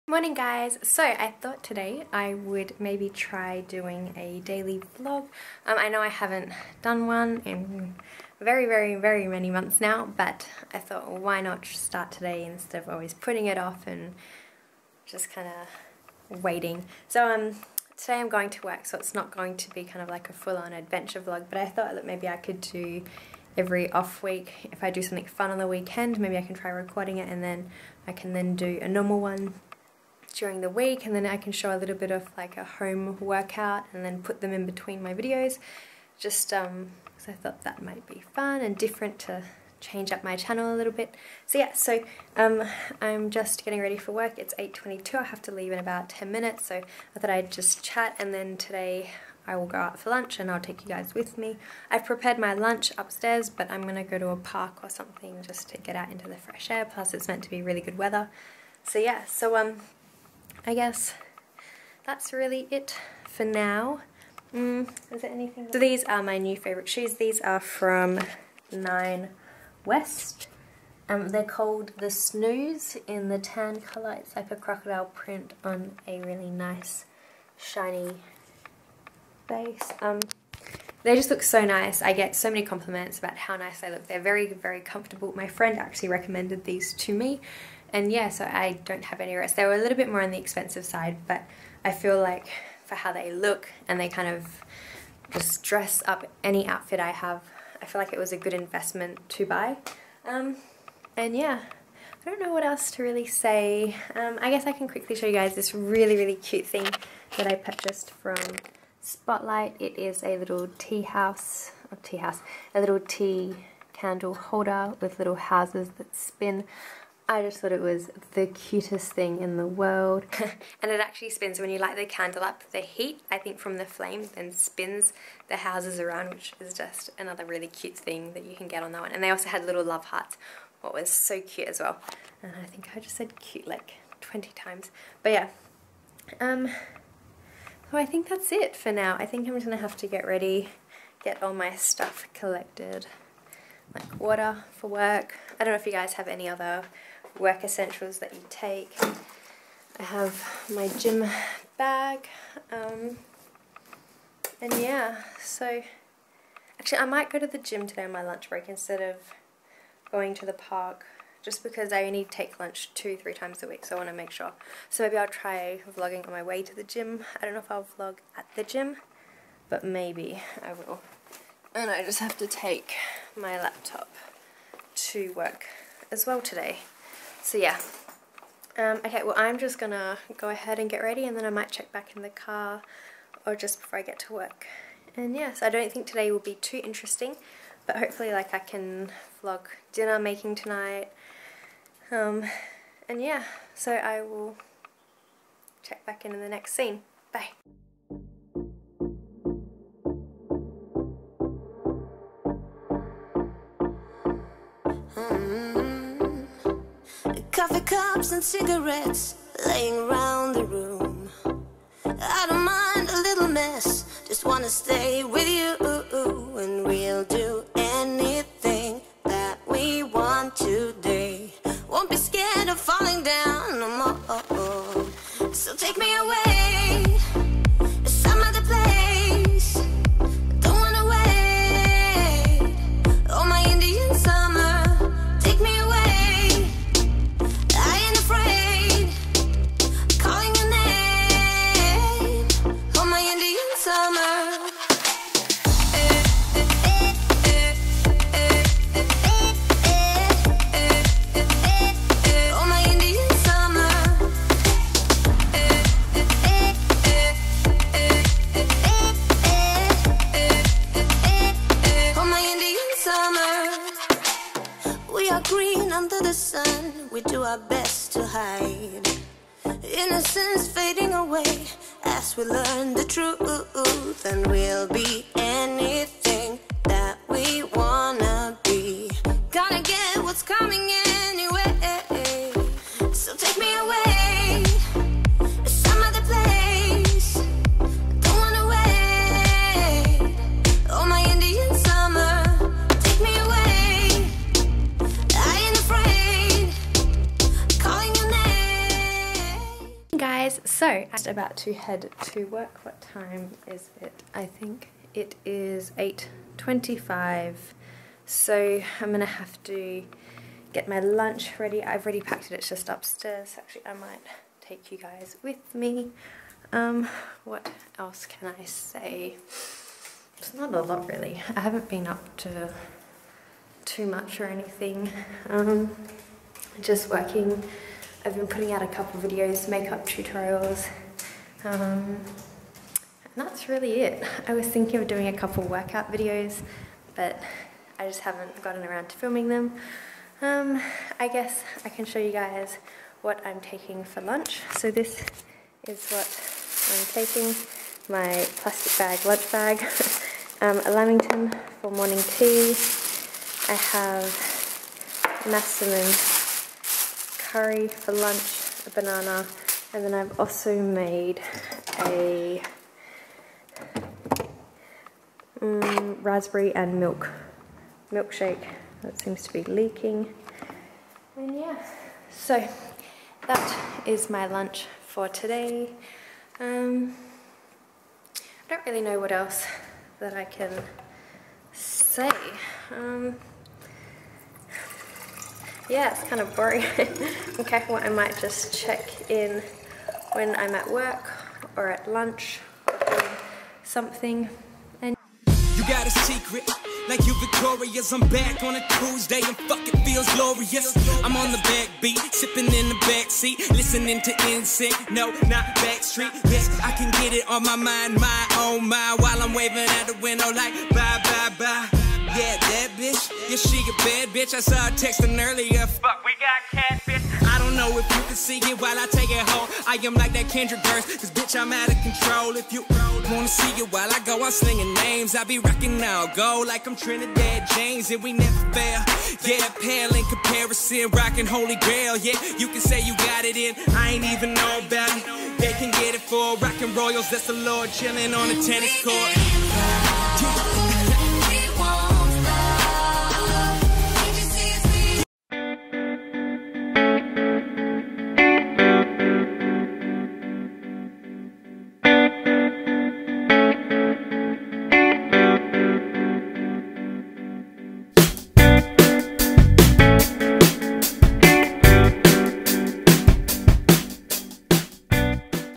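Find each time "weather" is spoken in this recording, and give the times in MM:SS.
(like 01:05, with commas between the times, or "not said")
00:57.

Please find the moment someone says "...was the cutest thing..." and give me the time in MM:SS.
01:57.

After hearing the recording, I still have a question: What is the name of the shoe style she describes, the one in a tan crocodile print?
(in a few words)
Snooze.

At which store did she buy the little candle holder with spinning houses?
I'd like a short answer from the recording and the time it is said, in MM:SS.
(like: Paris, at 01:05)
Spotlight, at 01:49.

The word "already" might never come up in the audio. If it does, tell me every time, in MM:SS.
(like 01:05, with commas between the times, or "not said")
05:12.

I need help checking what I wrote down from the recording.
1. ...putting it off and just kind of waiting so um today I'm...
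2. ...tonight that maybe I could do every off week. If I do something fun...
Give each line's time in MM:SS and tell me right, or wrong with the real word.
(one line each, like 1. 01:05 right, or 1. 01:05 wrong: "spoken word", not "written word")
1. 00:13 right
2. 00:21 wrong: "thought", not "tonight".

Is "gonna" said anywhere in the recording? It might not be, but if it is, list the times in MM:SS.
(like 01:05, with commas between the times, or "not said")
00:53, 02:59.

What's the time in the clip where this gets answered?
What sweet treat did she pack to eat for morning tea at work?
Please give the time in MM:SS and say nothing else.
05:50.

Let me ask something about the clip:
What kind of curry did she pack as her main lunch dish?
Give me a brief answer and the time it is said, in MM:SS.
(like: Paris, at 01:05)
massaman curry, at 05:55.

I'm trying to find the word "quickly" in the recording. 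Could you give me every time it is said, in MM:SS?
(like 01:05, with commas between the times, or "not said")
01:44.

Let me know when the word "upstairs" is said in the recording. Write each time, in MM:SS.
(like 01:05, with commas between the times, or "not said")
00:52, 05:12.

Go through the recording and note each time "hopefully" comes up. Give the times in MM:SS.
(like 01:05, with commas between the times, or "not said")
03:07.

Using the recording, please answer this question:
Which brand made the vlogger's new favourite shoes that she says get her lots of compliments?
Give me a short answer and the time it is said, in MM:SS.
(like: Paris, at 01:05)
Nine West, at 01:08.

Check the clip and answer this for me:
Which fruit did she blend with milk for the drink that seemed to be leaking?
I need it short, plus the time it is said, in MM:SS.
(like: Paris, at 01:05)
raspberry, at 06:06.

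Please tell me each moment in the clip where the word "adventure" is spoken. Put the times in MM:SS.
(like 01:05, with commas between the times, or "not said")
00:20.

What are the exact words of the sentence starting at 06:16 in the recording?
Um, I don't really know what else that I can say.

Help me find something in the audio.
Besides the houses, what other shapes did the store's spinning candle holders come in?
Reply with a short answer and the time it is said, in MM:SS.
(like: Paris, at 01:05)
love hearts, at 02:09.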